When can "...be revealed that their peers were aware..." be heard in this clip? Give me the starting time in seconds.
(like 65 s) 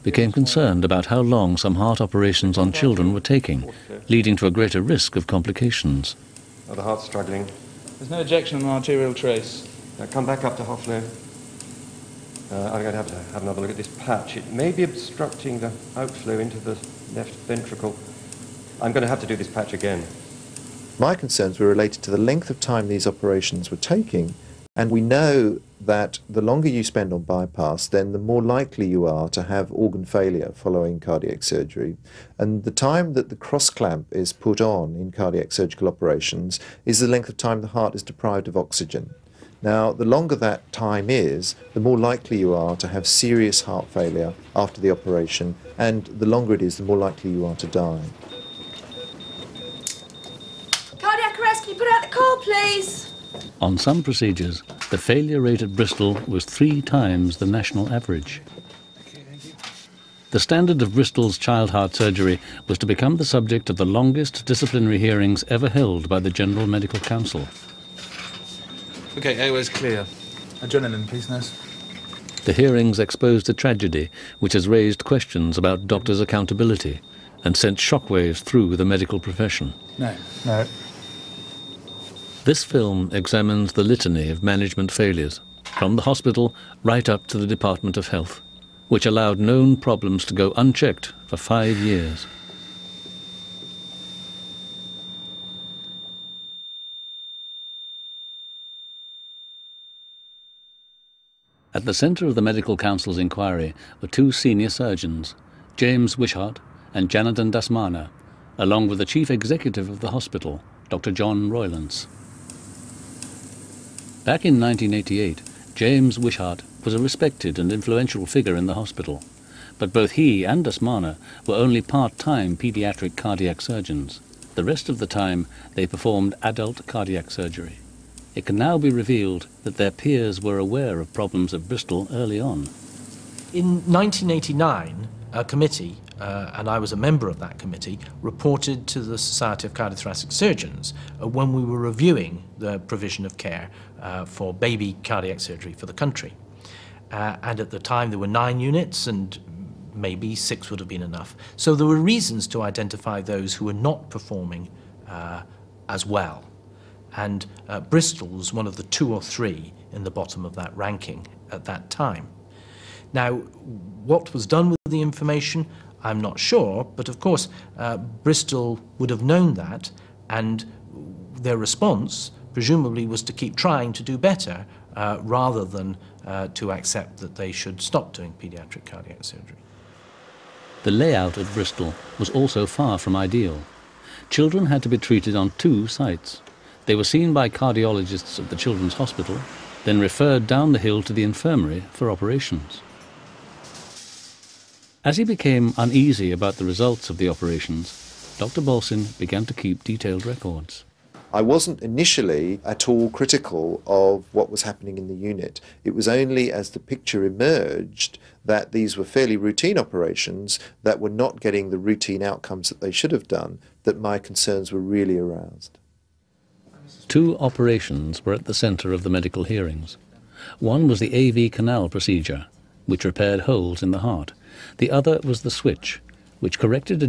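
128 s.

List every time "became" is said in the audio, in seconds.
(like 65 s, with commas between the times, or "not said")
0 s, 195 s.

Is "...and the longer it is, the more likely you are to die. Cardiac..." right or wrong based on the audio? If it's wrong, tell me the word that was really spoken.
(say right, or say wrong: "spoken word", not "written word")
right.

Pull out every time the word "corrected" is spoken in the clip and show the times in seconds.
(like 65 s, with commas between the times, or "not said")
226 s.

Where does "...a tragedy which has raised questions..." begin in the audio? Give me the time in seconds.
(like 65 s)
73 s.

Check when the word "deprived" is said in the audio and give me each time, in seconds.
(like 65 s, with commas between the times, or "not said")
38 s.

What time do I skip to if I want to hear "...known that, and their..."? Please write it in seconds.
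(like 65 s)
169 s.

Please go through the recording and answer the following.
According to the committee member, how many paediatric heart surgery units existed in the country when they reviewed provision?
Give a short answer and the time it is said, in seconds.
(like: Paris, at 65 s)
9, at 148 s.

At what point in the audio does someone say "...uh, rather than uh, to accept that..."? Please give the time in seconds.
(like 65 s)
174 s.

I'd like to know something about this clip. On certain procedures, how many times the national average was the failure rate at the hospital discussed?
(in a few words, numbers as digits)
3 times.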